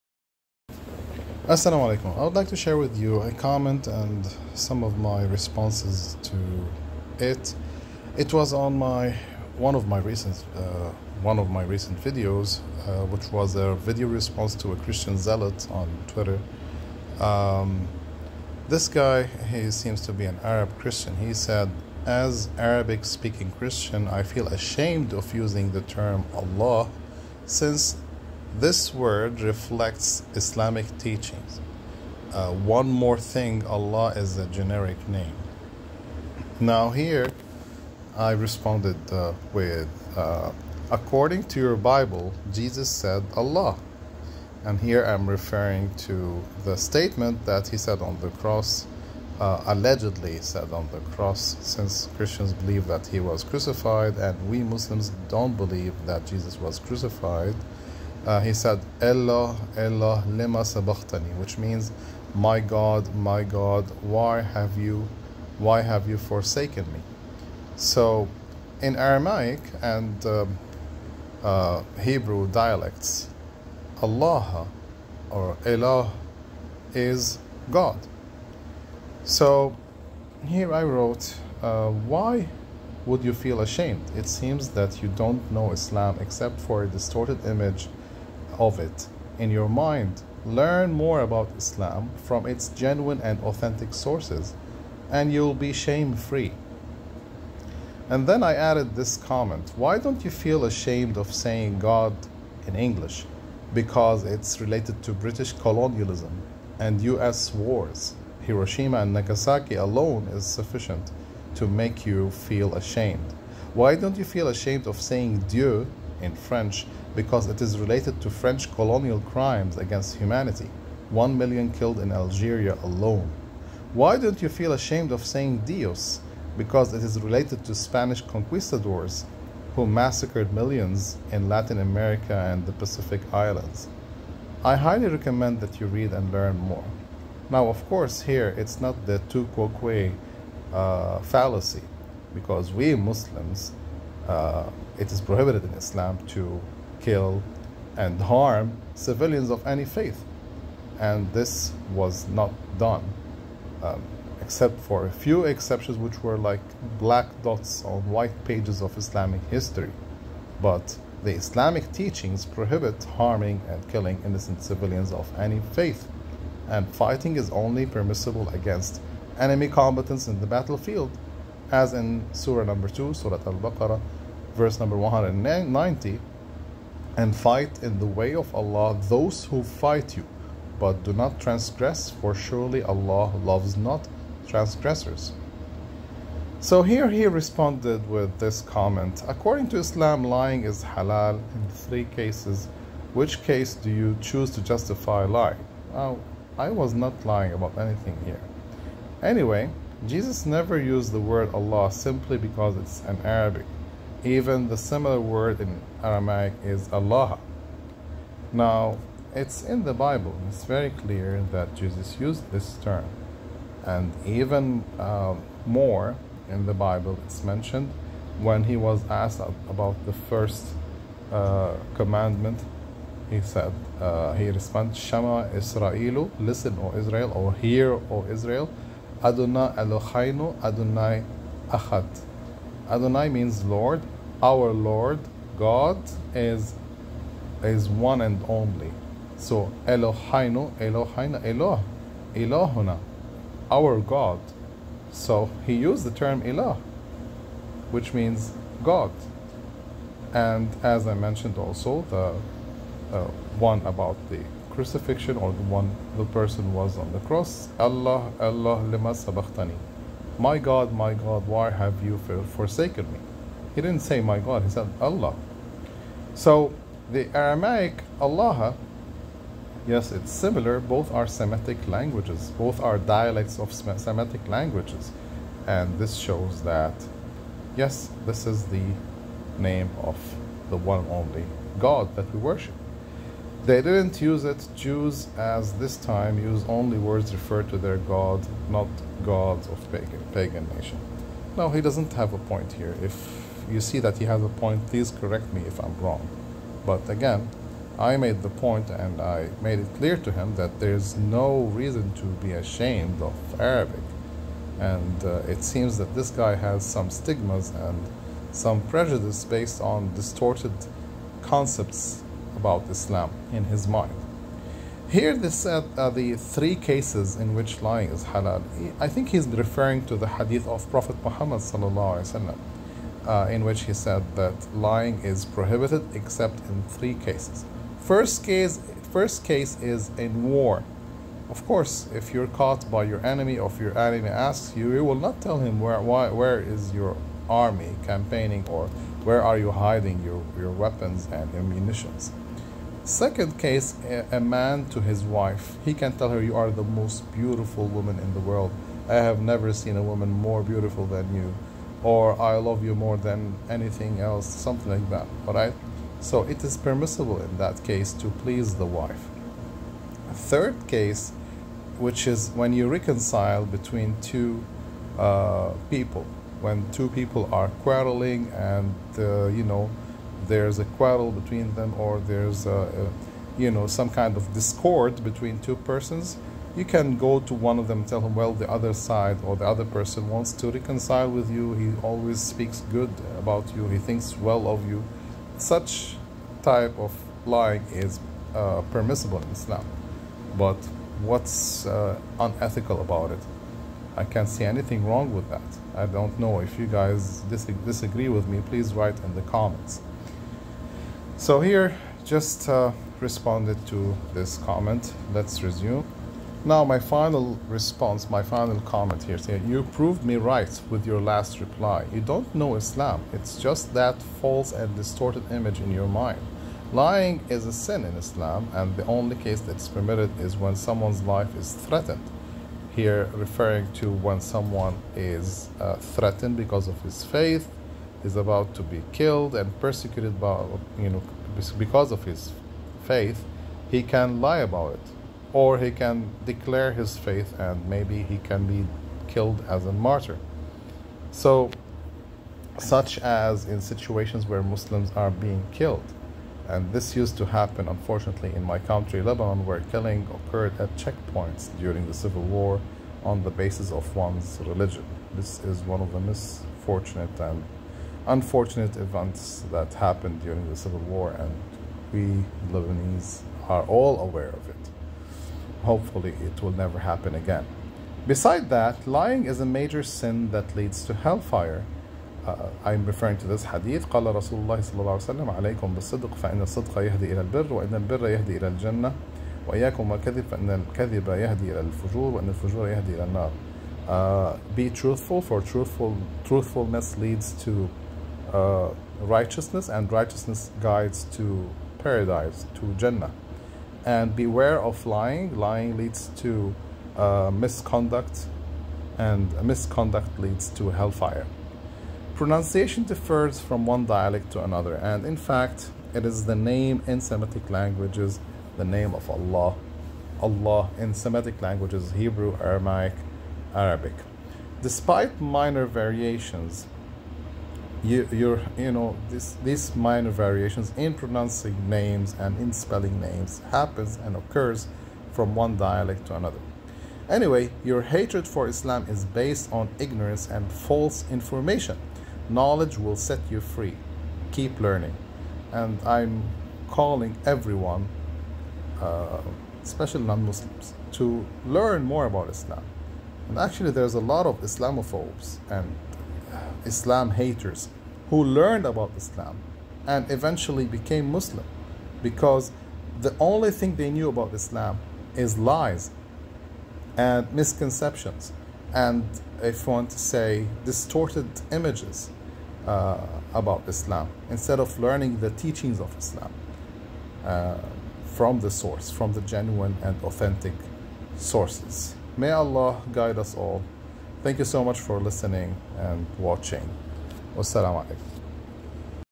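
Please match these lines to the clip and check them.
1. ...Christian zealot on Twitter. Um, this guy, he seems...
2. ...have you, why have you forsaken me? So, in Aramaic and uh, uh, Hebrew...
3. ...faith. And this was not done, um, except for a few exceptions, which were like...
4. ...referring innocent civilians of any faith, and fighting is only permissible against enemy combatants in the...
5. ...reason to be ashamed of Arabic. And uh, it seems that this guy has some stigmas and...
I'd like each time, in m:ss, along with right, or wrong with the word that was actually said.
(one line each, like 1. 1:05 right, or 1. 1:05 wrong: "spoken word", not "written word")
1. 0:14 right
2. 1:04 right
3. 2:29 right
4. 2:43 wrong: "killing", not "referring"
5. 5:01 right.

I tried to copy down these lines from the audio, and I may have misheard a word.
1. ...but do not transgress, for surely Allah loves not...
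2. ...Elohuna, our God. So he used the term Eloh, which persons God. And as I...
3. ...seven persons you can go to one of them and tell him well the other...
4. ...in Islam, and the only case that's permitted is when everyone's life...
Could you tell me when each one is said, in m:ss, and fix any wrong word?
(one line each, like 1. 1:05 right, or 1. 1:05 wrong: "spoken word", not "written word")
1. 3:00 right
2. 4:02 wrong: "means", not "persons"
3. 6:15 wrong: "two", not "seven"
4. 6:58 wrong: "someone", not "everyone".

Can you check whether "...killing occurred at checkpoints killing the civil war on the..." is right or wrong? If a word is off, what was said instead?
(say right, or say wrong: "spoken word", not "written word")
wrong: "during", not "killing".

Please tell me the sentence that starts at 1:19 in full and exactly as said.
So, here I wrote, uh, why would you feel ashamed?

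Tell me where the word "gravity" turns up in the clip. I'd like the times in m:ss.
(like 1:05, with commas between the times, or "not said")
not said.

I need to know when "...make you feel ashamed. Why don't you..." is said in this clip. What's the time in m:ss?
1:51.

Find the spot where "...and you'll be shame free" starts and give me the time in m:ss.
1:35.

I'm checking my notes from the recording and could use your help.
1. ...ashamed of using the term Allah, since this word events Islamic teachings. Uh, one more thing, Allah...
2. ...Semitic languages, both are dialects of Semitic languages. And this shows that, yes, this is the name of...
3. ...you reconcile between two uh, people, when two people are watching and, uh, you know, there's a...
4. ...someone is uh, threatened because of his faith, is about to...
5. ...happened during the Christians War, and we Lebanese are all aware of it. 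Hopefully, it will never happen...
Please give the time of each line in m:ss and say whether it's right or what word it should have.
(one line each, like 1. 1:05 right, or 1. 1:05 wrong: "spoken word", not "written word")
1. 0:24 wrong: "reflects", not "events"
2. 4:31 right
3. 6:02 wrong: "quarreling", not "watching"
4. 7:04 right
5. 7:39 wrong: "Civil", not "Christians".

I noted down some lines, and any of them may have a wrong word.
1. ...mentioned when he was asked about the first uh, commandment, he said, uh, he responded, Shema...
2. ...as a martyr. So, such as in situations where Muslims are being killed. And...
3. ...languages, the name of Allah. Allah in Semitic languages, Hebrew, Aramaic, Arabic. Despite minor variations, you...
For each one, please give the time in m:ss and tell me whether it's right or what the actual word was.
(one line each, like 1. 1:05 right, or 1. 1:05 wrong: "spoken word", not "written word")
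1. 3:37 right
2. 7:19 right
3. 8:27 right.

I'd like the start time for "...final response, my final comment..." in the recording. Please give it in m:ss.
6:46.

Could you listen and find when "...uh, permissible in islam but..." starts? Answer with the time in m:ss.
6:28.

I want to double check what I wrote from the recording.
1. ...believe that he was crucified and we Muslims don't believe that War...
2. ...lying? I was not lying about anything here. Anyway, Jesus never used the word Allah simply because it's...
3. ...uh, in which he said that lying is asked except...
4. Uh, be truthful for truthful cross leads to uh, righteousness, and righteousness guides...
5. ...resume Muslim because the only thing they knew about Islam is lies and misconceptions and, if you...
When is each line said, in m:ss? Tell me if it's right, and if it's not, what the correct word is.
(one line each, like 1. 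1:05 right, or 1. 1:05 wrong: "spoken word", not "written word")
1. 0:52 wrong: "Jesus", not "War"
2. 3:15 right
3. 5:23 wrong: "prohibited", not "asked"
4. 8:04 wrong: "truthfulness", not "cross"
5. 9:10 wrong: "became", not "resume".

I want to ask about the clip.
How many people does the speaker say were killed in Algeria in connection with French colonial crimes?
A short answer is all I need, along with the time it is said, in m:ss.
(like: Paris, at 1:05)
One million, at 2:01.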